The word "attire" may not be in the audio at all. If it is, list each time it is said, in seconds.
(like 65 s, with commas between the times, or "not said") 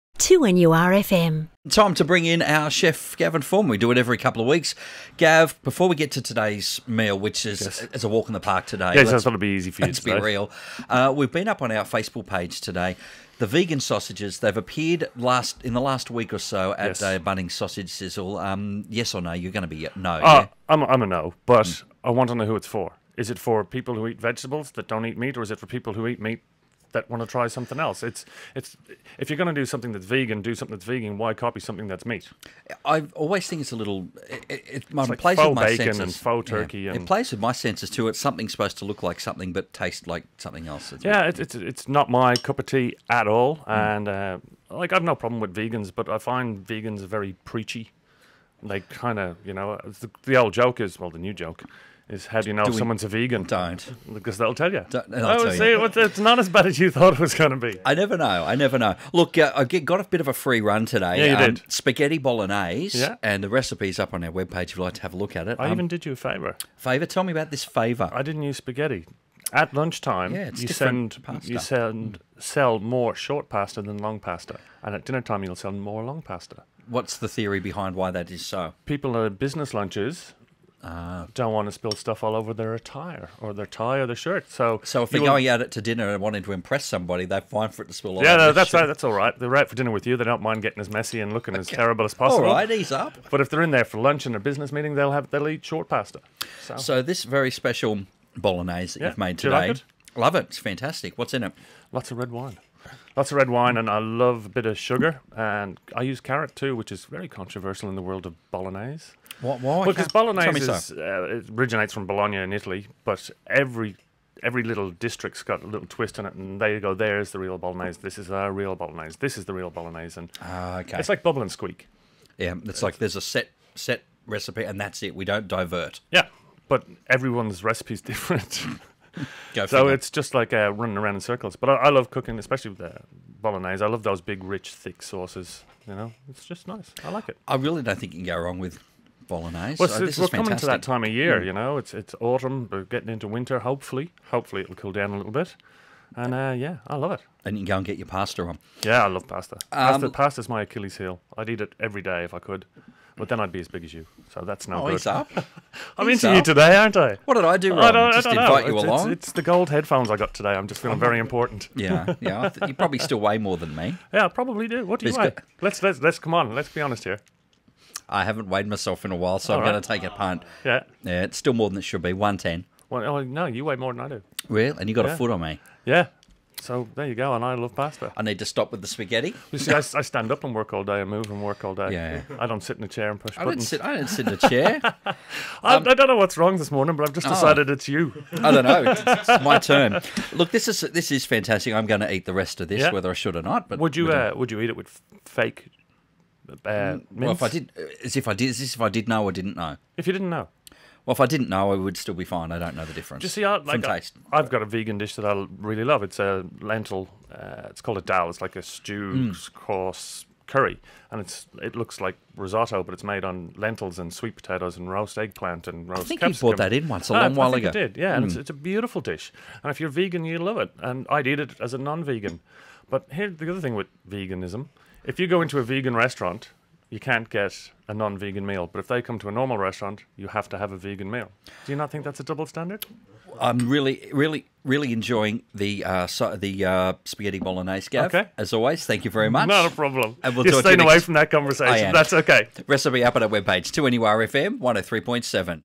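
82 s.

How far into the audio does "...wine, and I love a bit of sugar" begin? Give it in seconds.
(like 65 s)
103 s.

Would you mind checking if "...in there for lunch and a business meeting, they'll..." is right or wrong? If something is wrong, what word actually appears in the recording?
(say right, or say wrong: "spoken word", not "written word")
right.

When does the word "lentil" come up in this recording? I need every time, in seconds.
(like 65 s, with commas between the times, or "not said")
206 s, 213 s.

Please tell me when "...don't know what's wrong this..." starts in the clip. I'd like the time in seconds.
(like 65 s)
185 s.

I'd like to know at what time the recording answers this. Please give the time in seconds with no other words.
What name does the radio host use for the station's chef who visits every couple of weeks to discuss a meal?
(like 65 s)
3 s.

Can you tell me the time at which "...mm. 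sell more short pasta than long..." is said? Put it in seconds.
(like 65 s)
72 s.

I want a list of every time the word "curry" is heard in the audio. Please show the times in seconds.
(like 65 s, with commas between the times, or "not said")
210 s.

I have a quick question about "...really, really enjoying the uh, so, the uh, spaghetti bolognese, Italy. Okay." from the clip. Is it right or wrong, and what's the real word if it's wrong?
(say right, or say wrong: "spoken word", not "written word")
wrong: "Gav", not "Italy".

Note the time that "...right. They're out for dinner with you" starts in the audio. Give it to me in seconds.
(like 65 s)
89 s.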